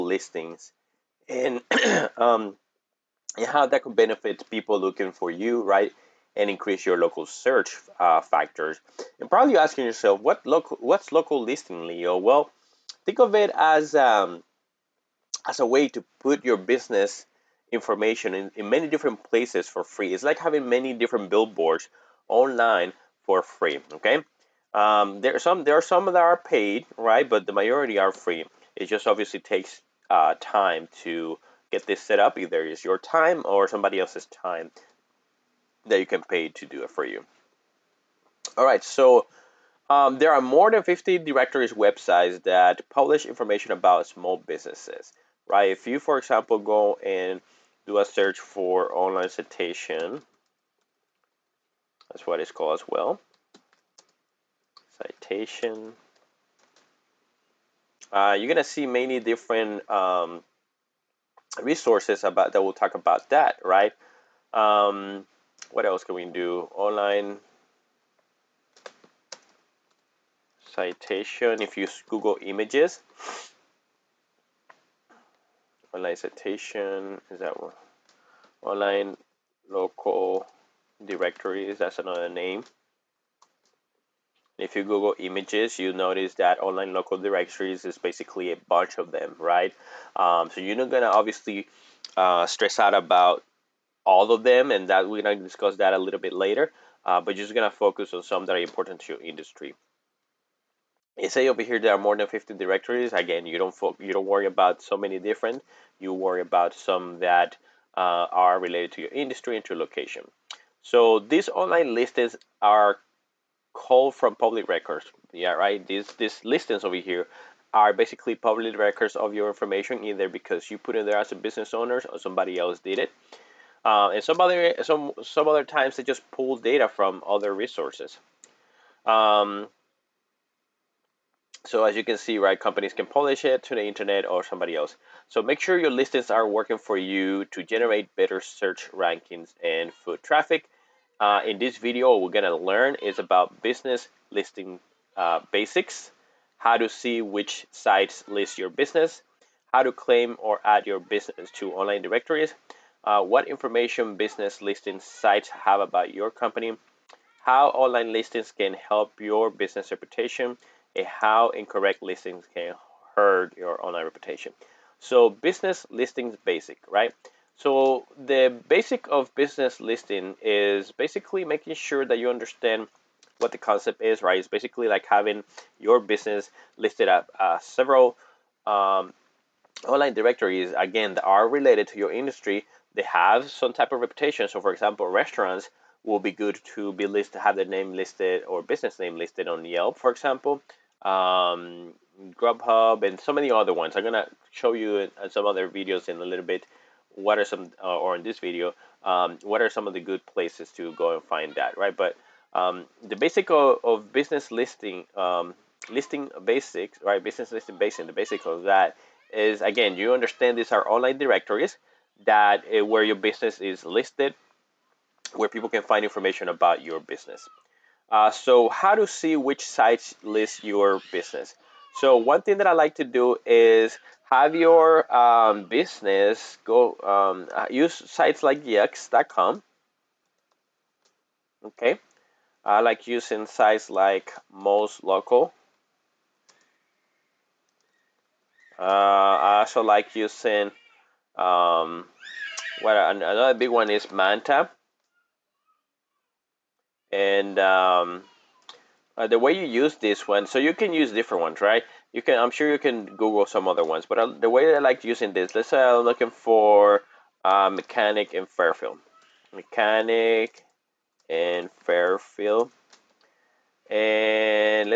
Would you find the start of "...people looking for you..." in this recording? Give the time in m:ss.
0:04.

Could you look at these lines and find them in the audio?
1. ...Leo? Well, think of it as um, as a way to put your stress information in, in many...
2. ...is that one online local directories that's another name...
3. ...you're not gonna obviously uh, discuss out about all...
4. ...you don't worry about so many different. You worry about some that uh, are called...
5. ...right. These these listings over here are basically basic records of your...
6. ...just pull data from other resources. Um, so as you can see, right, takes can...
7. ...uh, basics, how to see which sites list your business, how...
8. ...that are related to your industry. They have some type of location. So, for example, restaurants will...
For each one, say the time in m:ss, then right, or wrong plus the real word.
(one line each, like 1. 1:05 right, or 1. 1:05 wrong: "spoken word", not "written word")
1. 0:11 wrong: "business", not "stress"
2. 1:17 right
3. 1:30 wrong: "stress", not "discuss"
4. 1:44 wrong: "related", not "called"
5. 1:55 wrong: "public", not "basic"
6. 2:06 wrong: "companies", not "takes"
7. 2:25 right
8. 3:01 wrong: "reputation", not "location".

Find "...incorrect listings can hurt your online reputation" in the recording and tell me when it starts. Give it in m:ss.
2:41.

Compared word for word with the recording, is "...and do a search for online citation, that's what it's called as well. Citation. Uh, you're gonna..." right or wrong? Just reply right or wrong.
right.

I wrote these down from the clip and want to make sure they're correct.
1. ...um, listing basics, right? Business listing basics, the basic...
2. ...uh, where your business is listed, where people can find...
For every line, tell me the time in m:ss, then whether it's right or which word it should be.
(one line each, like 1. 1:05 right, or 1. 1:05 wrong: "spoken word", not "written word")
1. 3:25 right
2. 3:32 right.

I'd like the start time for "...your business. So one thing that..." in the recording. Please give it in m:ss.
3:40.